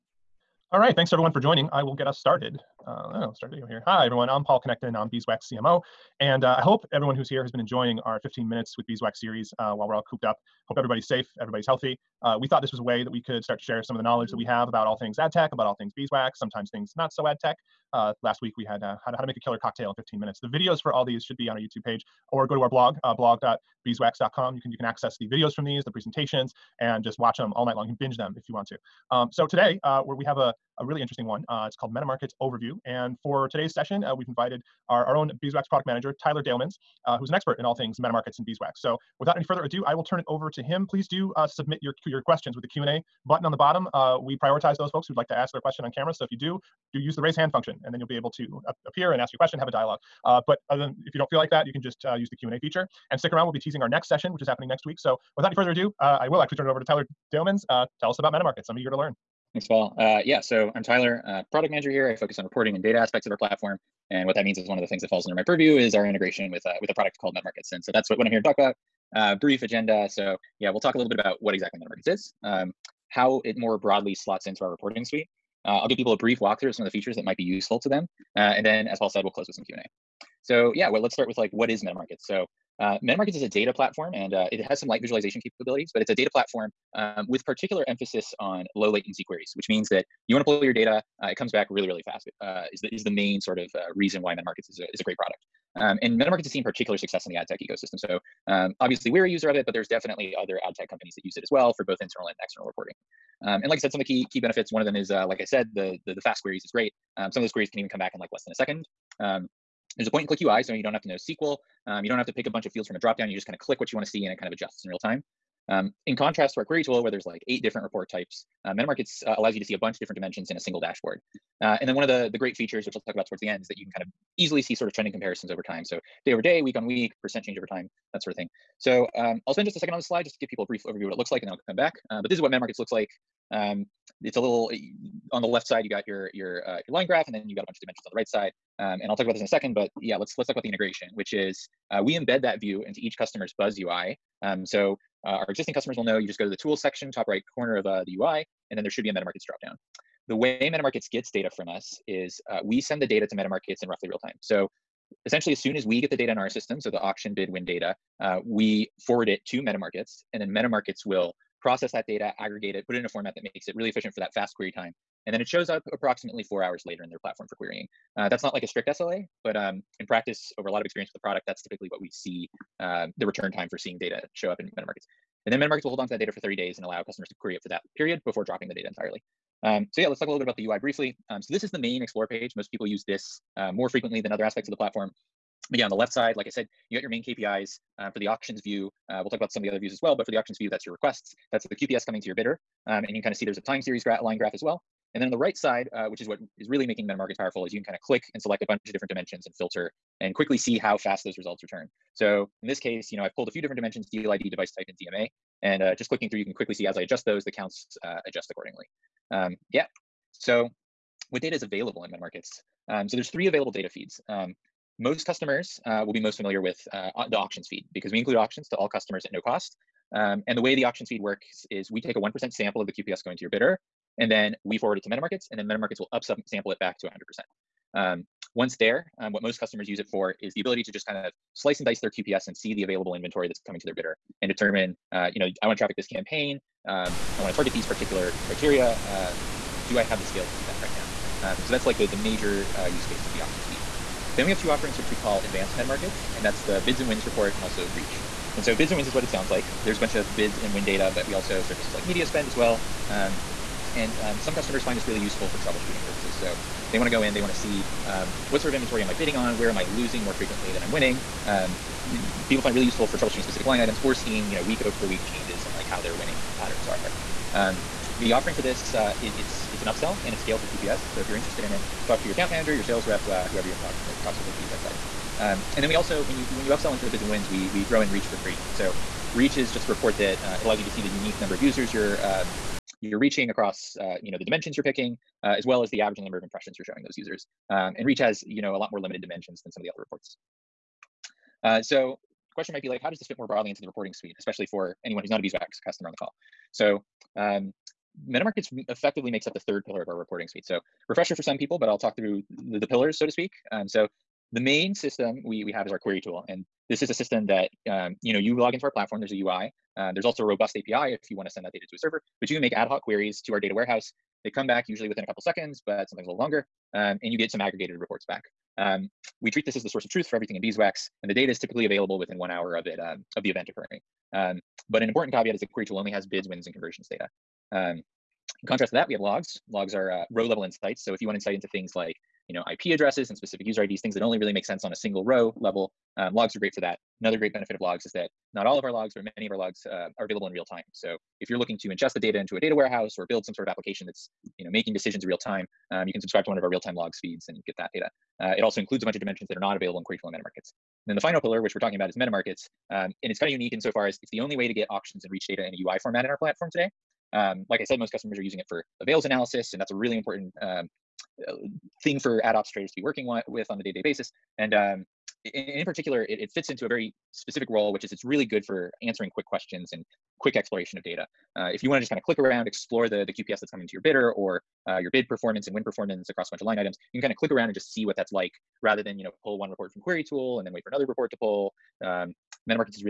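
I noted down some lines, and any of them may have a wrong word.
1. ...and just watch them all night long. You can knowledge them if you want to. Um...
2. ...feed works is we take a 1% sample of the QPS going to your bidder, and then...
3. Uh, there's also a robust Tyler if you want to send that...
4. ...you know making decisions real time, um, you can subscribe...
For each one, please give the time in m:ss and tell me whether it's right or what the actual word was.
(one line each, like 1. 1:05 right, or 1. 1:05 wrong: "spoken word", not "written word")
1. 0:26 wrong: "binge", not "knowledge"
2. 3:41 right
3. 5:09 wrong: "API", not "Tyler"
4. 5:44 right.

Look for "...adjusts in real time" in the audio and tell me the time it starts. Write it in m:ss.
1:54.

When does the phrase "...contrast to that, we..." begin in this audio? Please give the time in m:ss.
5:28.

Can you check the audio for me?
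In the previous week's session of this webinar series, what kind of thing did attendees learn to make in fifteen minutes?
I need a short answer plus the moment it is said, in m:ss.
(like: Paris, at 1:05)
A killer cocktail, at 0:19.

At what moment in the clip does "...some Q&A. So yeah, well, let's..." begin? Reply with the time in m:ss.
1:19.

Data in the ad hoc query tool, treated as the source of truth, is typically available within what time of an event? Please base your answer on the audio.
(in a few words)
1 hour.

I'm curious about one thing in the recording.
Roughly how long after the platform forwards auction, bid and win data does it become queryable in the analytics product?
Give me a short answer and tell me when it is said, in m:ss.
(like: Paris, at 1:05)
4 hours, at 2:46.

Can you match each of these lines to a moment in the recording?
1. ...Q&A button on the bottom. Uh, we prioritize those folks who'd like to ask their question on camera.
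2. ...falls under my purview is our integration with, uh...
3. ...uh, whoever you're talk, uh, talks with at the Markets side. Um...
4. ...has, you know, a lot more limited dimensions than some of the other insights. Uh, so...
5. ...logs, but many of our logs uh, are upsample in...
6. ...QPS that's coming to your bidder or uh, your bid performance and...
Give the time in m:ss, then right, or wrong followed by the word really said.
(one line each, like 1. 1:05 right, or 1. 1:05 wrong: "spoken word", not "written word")
1. 0:42 right
2. 1:05 right
3. 4:33 wrong: "Beeswax", not "Markets"
4. 4:48 wrong: "reports", not "insights"
5. 5:38 wrong: "available", not "upsample"
6. 6:13 right.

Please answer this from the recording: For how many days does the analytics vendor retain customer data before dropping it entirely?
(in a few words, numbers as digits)
30 days.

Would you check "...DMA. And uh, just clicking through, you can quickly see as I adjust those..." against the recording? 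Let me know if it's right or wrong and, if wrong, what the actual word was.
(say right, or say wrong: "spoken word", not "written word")
right.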